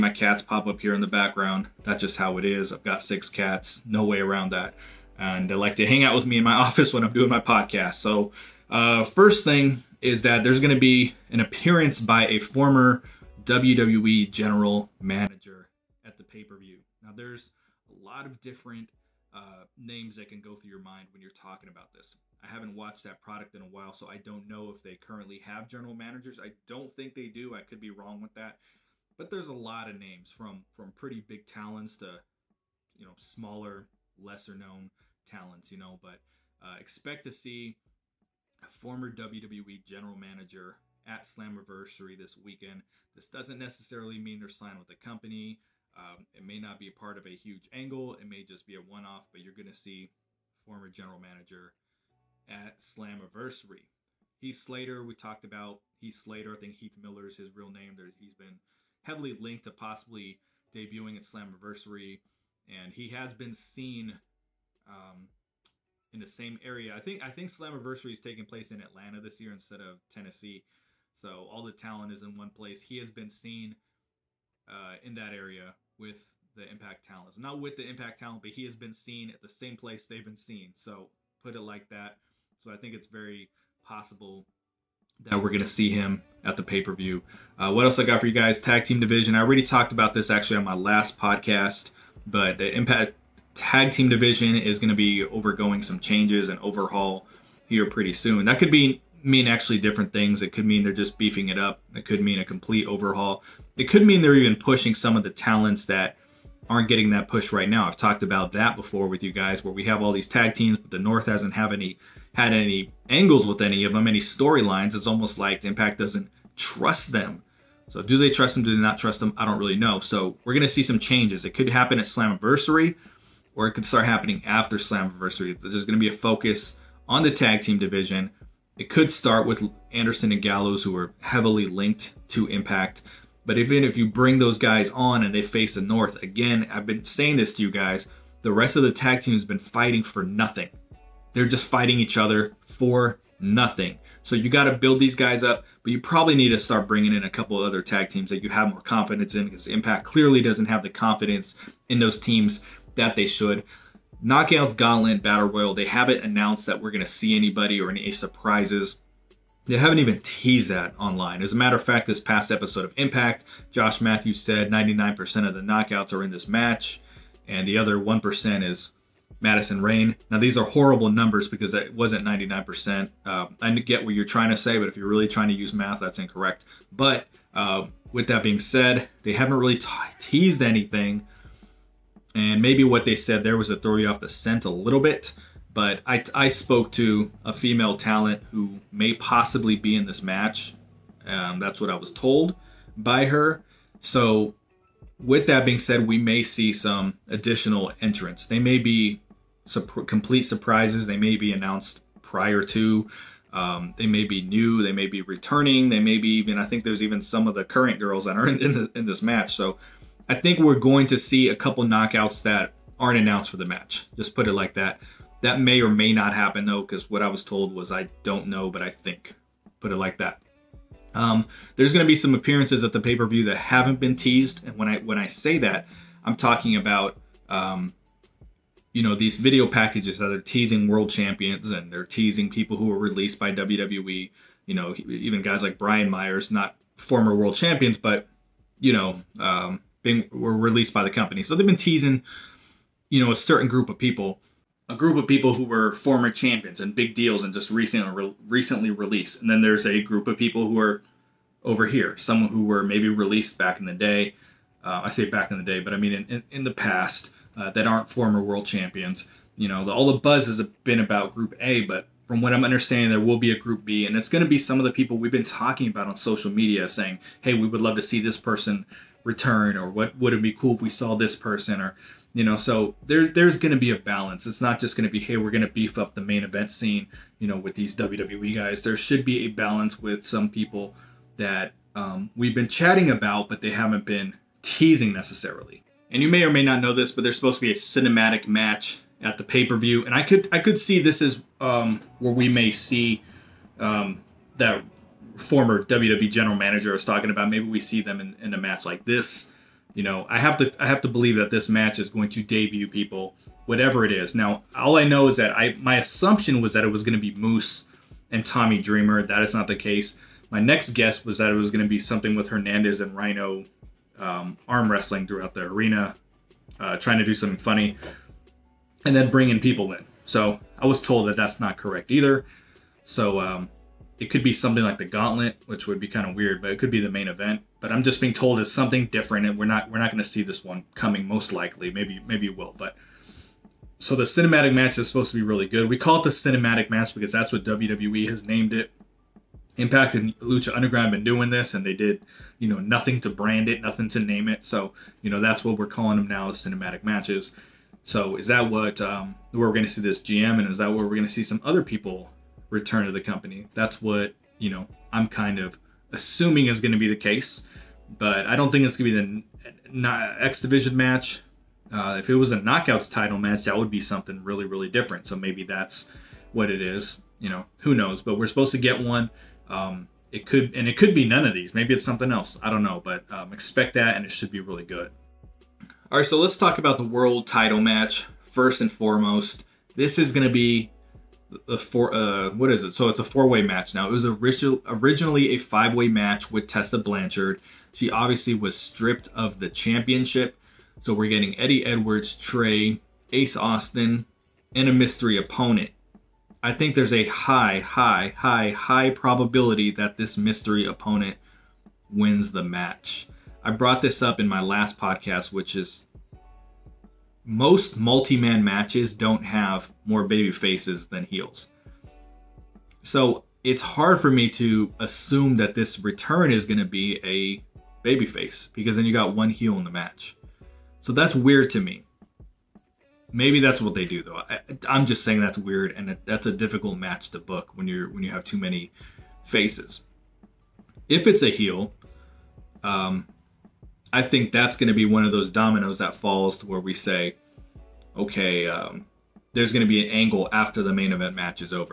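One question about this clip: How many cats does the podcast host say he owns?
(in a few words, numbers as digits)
6.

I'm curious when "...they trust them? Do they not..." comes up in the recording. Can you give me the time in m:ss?
1:58.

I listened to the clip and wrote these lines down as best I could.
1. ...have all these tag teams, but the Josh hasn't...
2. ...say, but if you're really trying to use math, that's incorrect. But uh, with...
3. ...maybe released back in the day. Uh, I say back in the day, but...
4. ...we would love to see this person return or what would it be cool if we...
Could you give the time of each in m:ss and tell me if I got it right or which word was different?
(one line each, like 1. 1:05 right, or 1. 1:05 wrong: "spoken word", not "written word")
1. 1:49 wrong: "North", not "Josh"
2. 2:54 right
3. 4:12 right
4. 4:27 right.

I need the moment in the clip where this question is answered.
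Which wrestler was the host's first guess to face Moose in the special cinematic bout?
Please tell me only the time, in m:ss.
5:08.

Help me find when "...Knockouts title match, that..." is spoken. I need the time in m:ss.
6:02.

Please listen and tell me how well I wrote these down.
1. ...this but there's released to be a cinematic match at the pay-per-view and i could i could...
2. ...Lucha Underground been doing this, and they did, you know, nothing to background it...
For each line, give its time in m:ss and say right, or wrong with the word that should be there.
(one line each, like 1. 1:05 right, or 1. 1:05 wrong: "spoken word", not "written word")
1. 4:46 wrong: "supposed", not "released"
2. 5:40 wrong: "brand", not "background".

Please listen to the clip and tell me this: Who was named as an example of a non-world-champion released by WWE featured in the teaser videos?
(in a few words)
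Brian Myers.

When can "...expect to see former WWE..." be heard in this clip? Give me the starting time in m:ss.
0:36.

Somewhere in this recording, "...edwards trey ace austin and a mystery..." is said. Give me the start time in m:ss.
6:31.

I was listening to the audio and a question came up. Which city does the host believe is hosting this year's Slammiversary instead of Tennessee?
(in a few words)
Atlanta.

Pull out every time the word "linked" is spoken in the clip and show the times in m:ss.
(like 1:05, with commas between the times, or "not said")
0:59, 2:11.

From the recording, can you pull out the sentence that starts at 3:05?
But I, I spoke to a female talent who may possibly be in this match.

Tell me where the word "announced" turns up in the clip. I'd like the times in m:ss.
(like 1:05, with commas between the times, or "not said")
2:36, 3:21, 3:33.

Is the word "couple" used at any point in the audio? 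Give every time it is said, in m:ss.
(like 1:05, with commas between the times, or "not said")
2:27, 3:31.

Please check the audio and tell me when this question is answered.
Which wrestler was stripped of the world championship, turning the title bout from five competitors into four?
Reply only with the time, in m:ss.
6:26.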